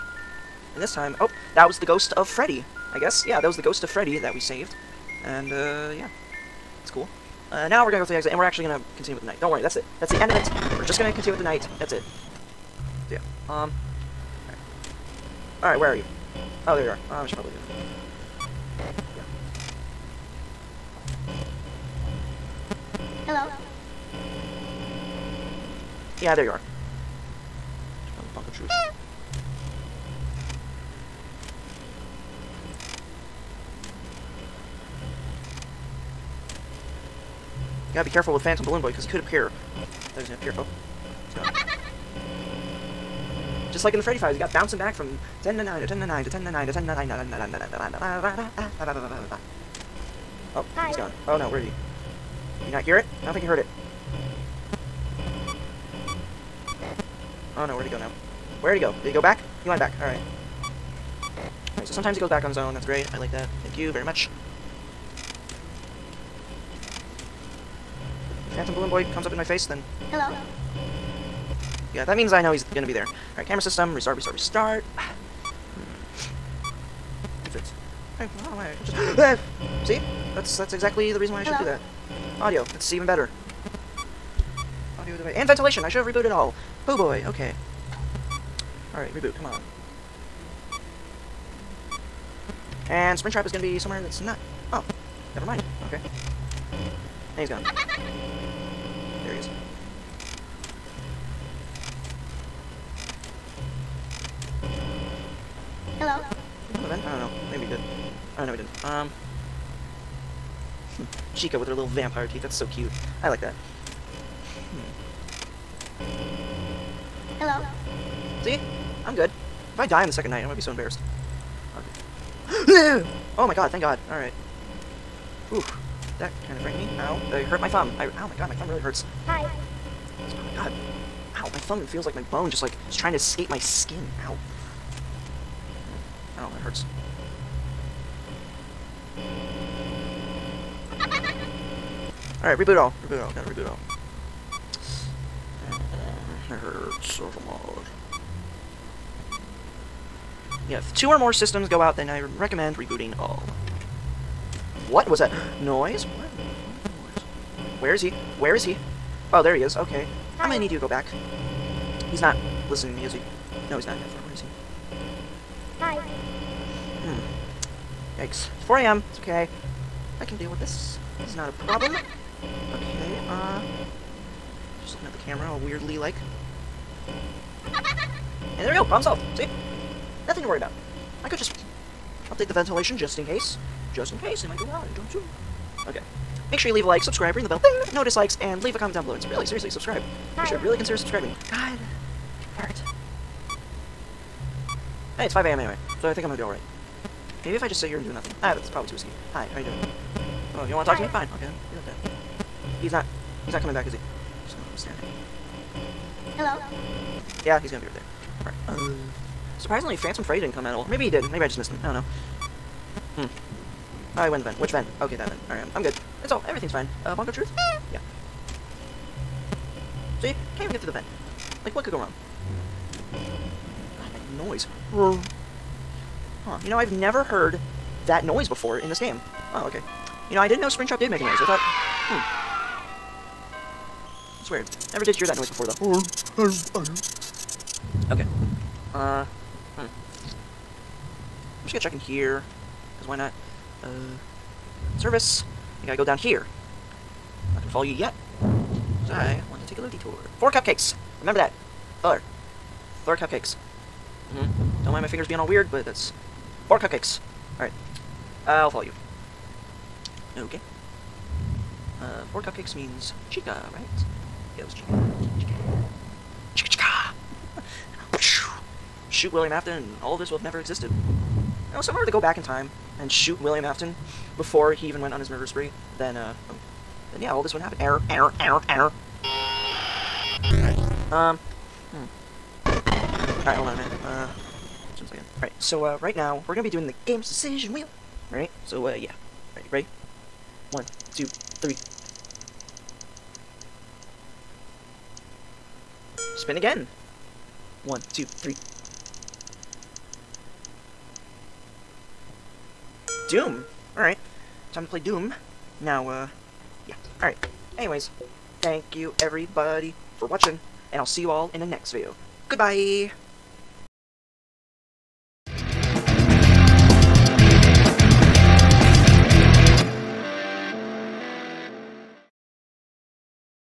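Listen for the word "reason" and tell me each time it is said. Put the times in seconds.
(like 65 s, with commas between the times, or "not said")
81 s.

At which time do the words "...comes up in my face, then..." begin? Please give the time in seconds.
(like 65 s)
69 s.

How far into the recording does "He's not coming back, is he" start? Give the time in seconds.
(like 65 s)
203 s.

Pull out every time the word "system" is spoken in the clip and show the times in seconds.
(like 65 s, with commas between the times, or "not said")
73 s, 151 s.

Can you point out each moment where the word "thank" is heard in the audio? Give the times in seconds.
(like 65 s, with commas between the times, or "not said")
63 s, 123 s, 308 s.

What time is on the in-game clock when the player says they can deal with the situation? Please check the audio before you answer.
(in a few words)
4 a.m.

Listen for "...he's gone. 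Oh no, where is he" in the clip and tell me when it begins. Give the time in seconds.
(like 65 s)
50 s.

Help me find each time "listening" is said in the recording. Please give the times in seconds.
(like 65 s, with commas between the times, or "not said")
162 s.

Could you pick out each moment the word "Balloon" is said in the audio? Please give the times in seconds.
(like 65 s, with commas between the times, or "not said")
38 s, 68 s.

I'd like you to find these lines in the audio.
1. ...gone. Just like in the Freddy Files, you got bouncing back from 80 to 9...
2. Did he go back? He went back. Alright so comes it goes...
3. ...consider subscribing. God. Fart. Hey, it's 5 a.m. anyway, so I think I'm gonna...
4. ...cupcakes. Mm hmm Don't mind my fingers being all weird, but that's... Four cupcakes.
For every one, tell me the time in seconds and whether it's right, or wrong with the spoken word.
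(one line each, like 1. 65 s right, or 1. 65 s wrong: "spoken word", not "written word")
1. 41 s wrong: "10", not "80"
2. 59 s wrong: "sometimes", not "comes"
3. 190 s right
4. 253 s right.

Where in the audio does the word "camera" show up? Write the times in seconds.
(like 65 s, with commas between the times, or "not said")
73 s, 175 s.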